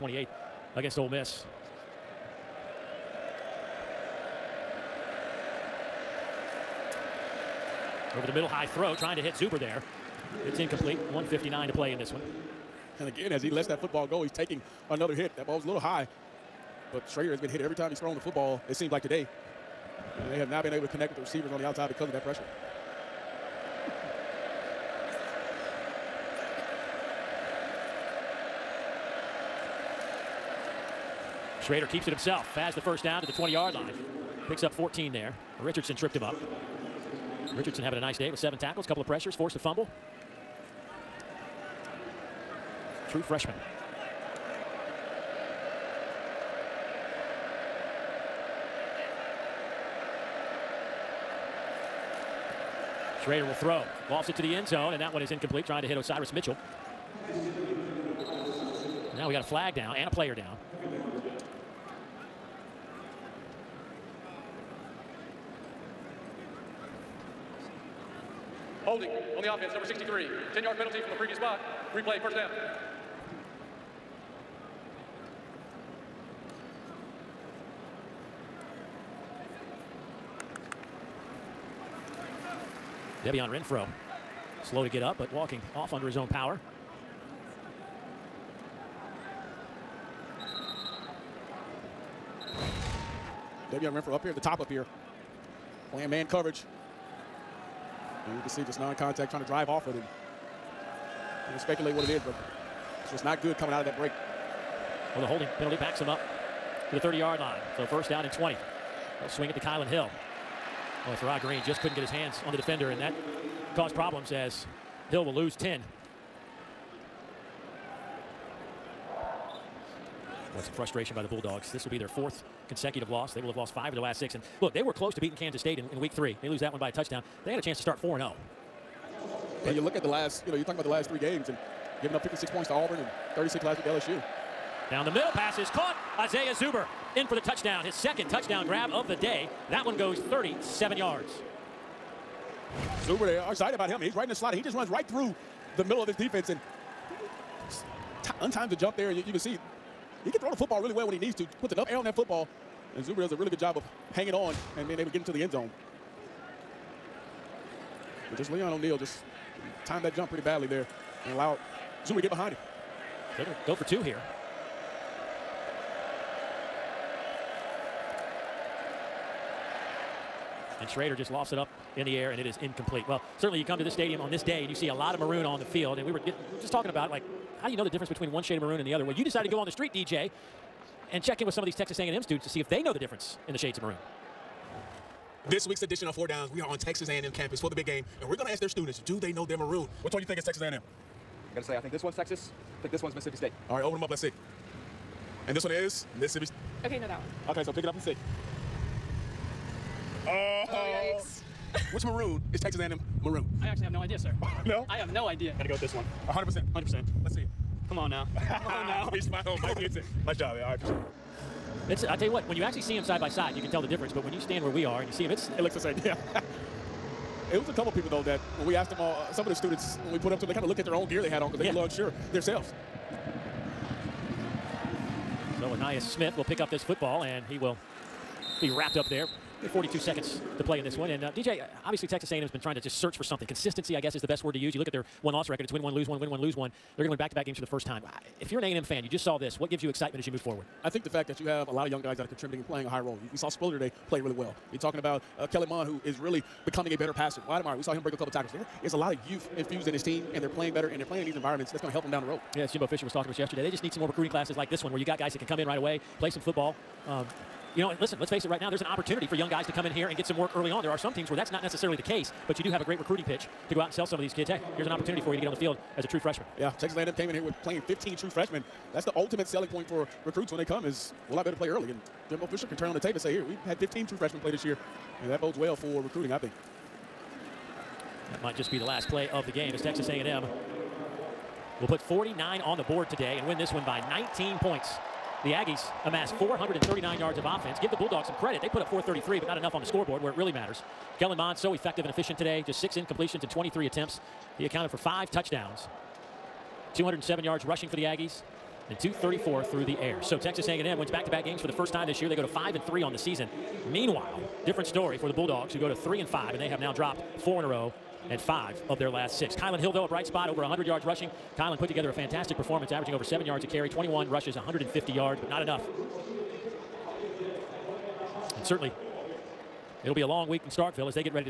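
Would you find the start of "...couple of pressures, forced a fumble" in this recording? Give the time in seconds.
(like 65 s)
38 s.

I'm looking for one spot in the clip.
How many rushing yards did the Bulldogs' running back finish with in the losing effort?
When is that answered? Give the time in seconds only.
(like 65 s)
314 s.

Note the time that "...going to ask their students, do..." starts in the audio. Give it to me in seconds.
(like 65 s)
188 s.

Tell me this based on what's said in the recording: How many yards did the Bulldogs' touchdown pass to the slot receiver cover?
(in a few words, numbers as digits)
37.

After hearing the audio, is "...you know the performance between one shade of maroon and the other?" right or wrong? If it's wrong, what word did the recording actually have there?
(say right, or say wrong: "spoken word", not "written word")
wrong: "difference", not "performance".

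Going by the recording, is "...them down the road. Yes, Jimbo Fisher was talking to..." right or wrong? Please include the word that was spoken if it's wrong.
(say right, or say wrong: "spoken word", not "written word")
right.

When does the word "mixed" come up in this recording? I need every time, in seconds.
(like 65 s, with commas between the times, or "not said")
not said.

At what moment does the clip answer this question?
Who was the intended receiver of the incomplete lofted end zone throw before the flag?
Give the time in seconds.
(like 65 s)
55 s.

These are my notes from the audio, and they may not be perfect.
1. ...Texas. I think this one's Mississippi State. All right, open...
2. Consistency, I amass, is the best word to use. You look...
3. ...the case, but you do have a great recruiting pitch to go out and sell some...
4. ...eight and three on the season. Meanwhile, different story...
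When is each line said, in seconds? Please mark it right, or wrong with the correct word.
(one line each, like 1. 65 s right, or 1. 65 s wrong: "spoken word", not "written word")
1. 192 s right
2. 233 s wrong: "guess", not "amass"
3. 261 s right
4. 302 s wrong: "five", not "eight".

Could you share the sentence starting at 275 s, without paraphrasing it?
And that bodes well for recruiting, I think.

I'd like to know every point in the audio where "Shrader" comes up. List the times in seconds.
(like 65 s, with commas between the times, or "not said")
17 s, 31 s, 53 s, 170 s.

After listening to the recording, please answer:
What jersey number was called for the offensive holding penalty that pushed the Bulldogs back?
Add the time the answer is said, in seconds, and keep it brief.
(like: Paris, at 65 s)
63, at 69 s.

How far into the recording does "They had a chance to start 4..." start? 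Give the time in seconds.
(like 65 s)
127 s.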